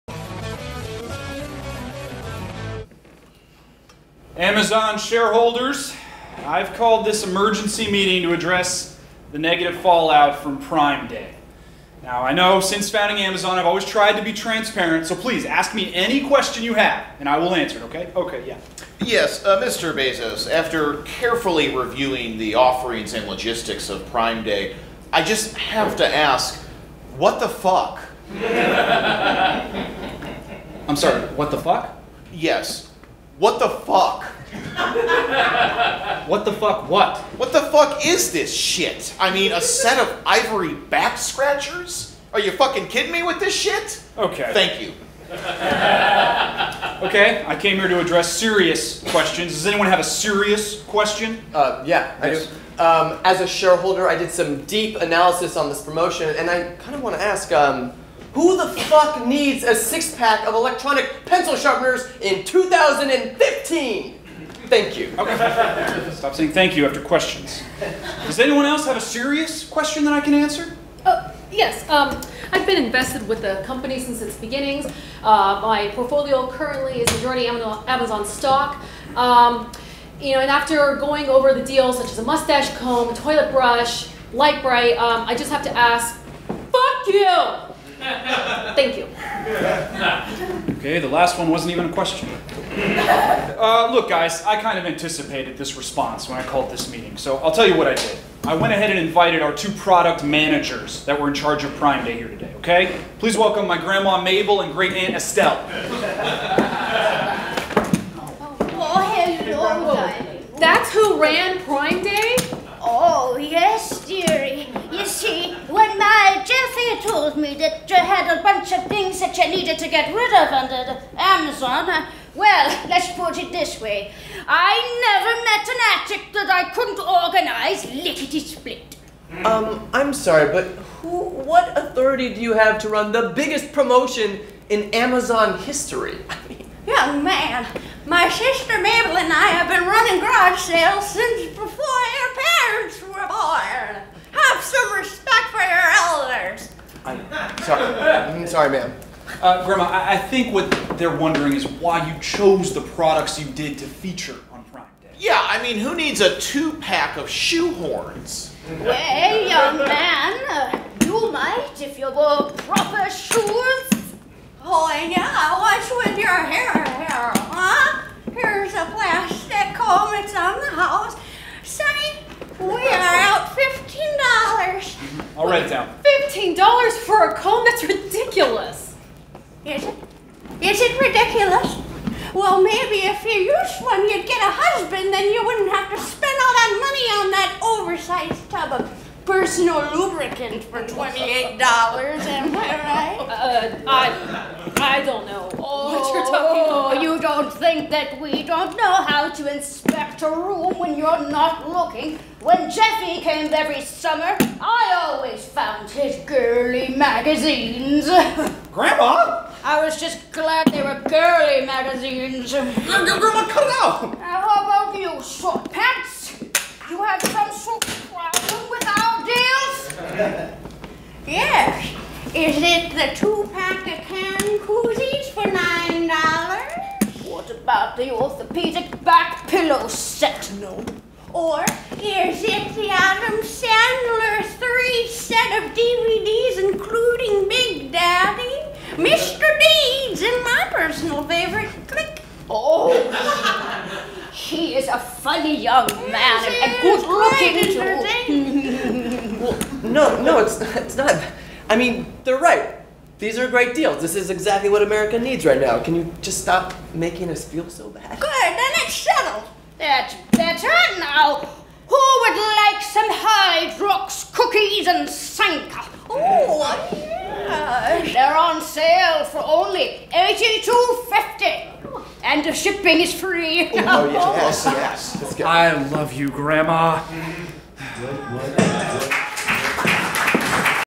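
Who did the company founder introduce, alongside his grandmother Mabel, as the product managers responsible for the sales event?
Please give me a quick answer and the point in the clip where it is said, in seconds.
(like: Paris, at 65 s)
Great aunt Estelle, at 104 s.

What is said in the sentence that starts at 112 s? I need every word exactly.
Oh, yes, dear told me that you had a bunch of things that you needed to get rid of under the Amazon.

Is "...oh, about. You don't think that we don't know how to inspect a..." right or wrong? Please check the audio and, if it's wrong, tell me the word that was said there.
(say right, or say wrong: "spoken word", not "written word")
right.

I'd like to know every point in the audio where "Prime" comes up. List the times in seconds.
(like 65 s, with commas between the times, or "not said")
10 s, 24 s, 101 s, 111 s, 154 s.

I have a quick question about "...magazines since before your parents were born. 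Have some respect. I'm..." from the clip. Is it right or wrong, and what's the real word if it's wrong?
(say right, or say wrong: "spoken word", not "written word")
wrong: "sales", not "magazines".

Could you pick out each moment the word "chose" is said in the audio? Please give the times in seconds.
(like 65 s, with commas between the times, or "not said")
152 s.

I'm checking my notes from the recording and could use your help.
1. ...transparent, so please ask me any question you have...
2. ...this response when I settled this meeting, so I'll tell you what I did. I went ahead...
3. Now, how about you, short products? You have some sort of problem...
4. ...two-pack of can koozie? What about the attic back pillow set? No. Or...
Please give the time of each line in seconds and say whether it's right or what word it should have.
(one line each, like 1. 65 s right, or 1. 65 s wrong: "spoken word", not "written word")
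1. 14 s right
2. 95 s wrong: "called", not "settled"
3. 214 s wrong: "pants", not "products"
4. 223 s wrong: "orthopedic", not "attic".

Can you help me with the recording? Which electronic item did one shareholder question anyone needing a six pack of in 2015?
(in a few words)
Electronic pencil sharpeners.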